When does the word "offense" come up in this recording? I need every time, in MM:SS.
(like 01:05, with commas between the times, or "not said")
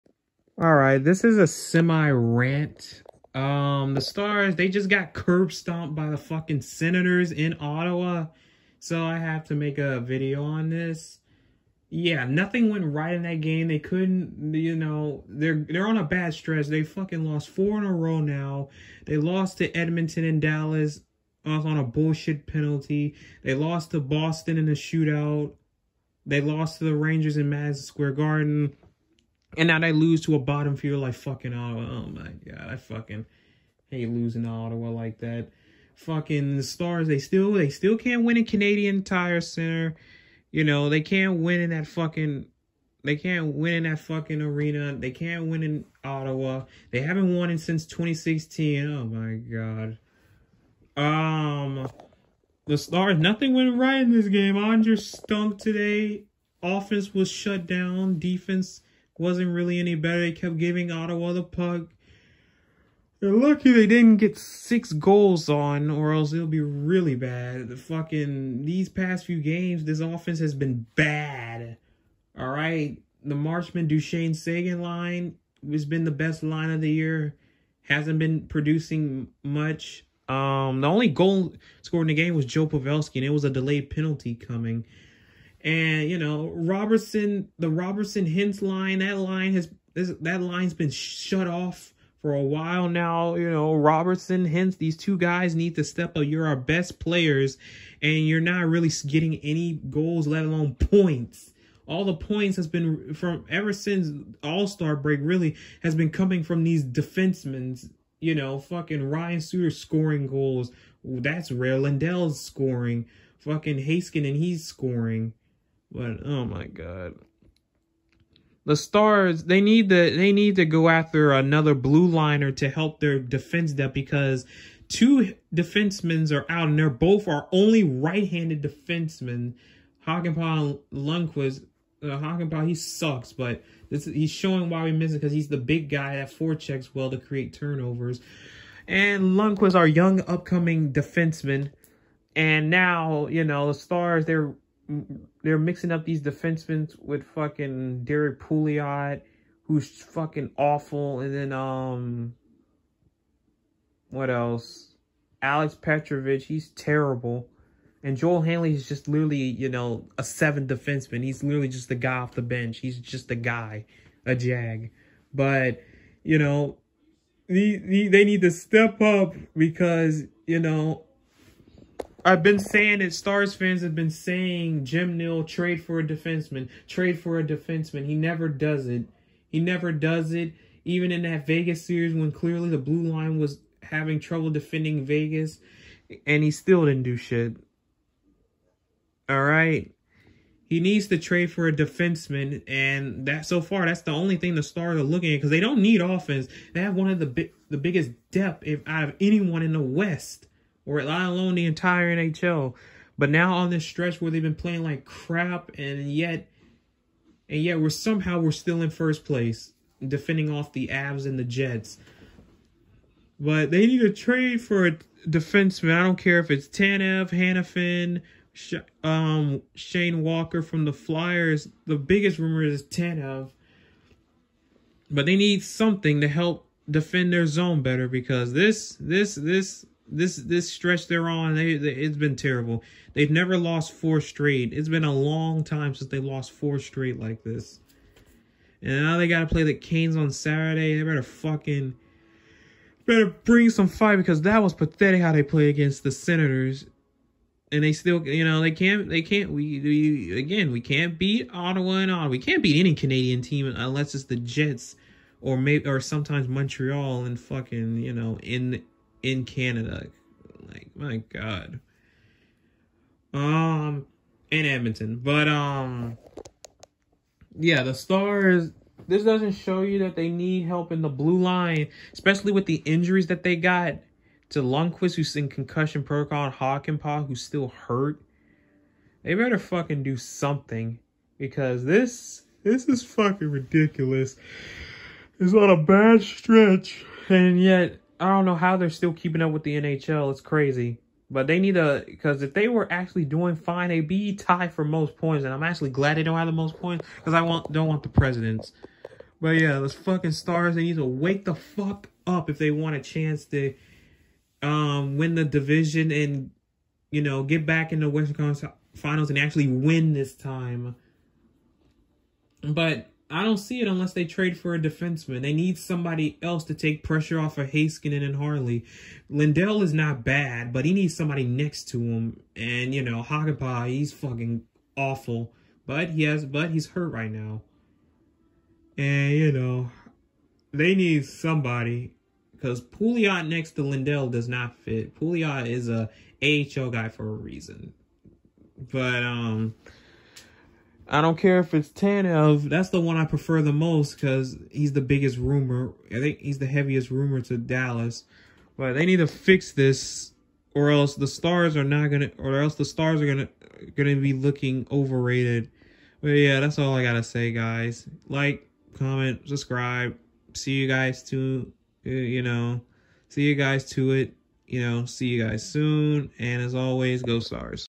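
00:56, 01:09, 03:16.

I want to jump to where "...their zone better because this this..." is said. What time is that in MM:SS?
03:47.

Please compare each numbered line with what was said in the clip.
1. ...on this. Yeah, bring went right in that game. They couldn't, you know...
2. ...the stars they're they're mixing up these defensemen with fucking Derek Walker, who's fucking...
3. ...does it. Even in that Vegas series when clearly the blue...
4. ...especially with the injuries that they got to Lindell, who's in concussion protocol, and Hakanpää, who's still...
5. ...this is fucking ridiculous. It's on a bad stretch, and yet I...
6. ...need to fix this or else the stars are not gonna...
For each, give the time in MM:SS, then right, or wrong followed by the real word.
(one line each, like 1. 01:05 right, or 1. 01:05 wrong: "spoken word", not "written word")
1. 00:10 wrong: "nothing", not "bring"
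2. 02:23 wrong: "Pouliot", not "Walker"
3. 02:59 right
4. 04:32 wrong: "Lundkvist", not "Lindell"
5. 04:42 right
6. 05:49 right.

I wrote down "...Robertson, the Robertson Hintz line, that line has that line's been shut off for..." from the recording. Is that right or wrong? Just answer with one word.
right.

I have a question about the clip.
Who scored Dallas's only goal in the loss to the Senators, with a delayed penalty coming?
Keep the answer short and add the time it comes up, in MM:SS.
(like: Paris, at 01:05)
Joe Pavelski, at 01:22.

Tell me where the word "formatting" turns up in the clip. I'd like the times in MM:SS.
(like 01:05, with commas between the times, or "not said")
not said.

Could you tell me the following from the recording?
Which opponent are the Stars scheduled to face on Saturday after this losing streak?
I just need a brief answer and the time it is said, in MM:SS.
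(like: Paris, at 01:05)
the Canes, at 03:59.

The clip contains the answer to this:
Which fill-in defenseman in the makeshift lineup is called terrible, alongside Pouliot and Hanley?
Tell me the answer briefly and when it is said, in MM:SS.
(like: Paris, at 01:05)
Alex Petrovic, at 02:35.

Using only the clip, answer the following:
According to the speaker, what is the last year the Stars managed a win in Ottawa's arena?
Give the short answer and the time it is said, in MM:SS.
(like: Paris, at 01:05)
2016, at 00:47.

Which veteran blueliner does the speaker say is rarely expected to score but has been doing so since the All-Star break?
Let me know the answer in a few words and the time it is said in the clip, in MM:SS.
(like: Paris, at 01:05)
Ryan Suter, at 01:49.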